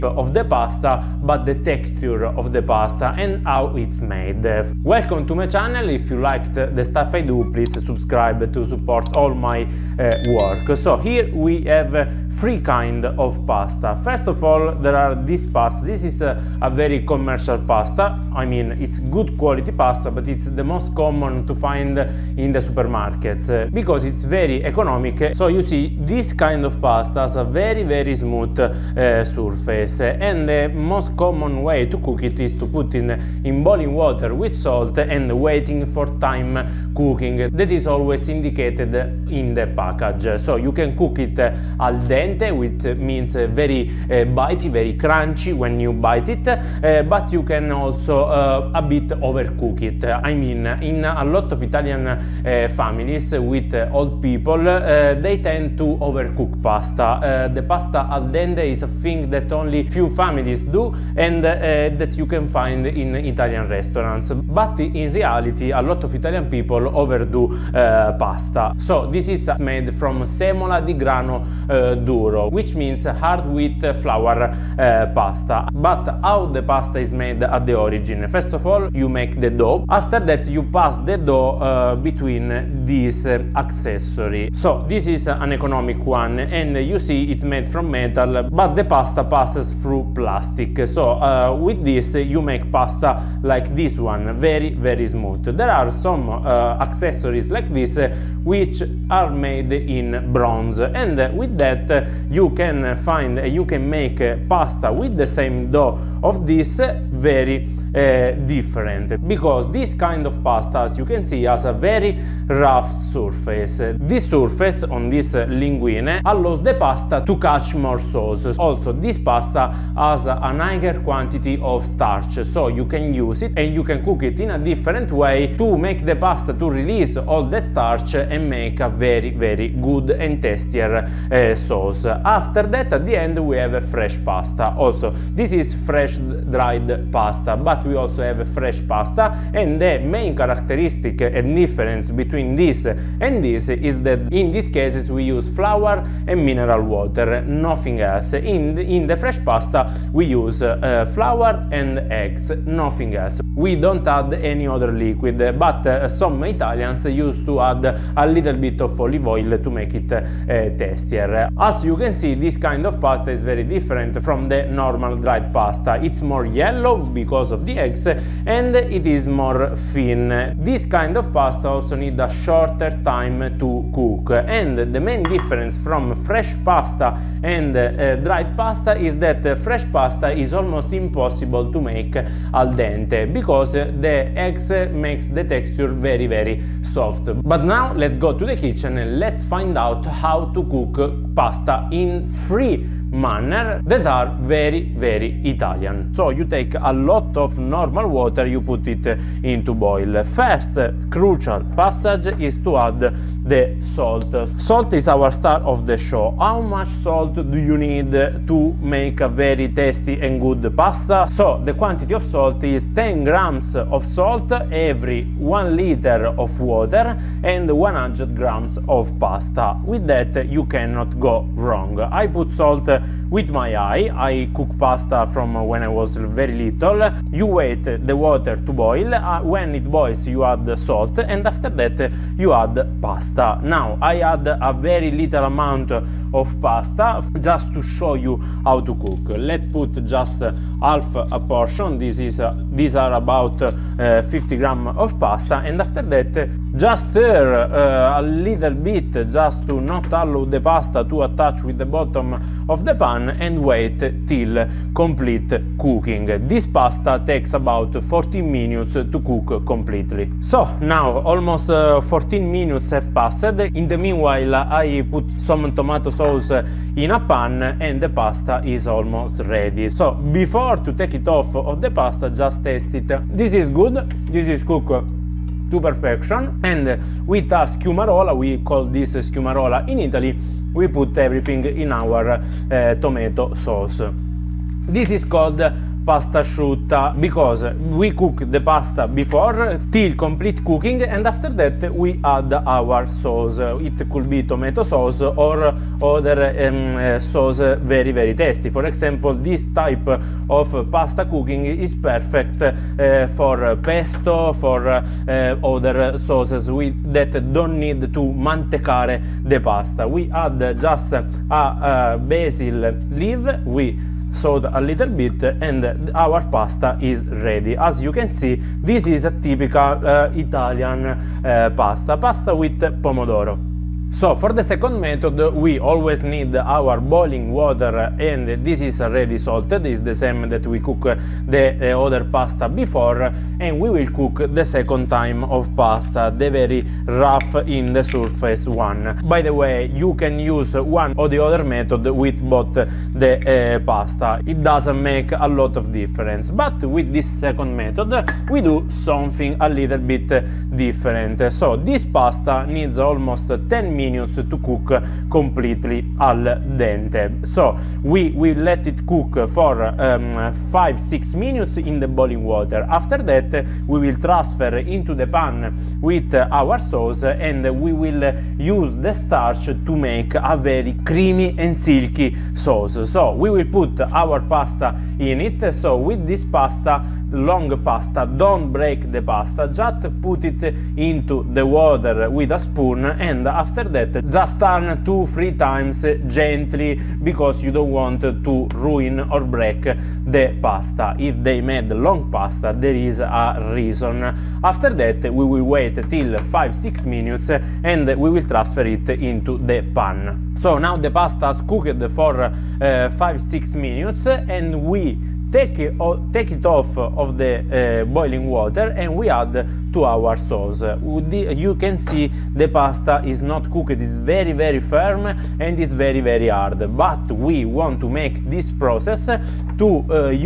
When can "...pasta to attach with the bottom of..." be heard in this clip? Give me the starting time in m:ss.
4:10.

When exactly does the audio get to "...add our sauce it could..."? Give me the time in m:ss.
4:52.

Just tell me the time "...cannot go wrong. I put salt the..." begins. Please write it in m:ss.
3:40.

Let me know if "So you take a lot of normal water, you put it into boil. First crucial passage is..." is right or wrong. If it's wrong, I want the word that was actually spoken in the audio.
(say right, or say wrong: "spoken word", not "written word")
right.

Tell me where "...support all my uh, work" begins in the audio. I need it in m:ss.
0:08.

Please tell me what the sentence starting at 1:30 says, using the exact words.
So uh, with this you make pasta like this one, very very smooth.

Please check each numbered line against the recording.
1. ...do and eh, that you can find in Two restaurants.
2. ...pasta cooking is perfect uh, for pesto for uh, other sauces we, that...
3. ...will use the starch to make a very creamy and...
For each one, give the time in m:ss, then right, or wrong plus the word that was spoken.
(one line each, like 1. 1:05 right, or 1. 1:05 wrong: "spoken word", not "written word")
1. 1:00 wrong: "Italian", not "Two"
2. 5:00 right
3. 6:07 right.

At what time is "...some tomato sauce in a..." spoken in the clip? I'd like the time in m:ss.
4:25.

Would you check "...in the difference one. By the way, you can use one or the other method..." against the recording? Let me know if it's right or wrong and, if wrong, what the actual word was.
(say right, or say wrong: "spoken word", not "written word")
wrong: "surface", not "difference".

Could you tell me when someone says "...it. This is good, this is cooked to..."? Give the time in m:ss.
4:32.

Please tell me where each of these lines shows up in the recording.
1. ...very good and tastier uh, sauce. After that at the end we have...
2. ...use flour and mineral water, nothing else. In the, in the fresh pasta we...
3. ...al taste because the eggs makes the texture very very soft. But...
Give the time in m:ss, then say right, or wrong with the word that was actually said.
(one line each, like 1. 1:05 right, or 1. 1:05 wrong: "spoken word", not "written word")
1. 2:09 right
2. 2:25 right
3. 3:02 wrong: "dente", not "taste".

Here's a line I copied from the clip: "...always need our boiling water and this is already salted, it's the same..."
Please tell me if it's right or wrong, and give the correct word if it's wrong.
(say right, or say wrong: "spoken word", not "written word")
right.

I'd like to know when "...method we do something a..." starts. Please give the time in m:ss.
5:47.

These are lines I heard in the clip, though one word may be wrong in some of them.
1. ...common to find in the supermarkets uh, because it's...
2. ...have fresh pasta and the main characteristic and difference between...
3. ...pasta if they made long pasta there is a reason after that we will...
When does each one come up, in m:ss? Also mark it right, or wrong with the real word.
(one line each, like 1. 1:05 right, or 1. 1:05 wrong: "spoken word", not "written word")
1. 0:20 right
2. 2:18 right
3. 6:30 right.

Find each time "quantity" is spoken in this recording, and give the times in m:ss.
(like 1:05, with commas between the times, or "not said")
2:00, 3:31.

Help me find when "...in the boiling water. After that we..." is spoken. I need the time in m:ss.
6:01.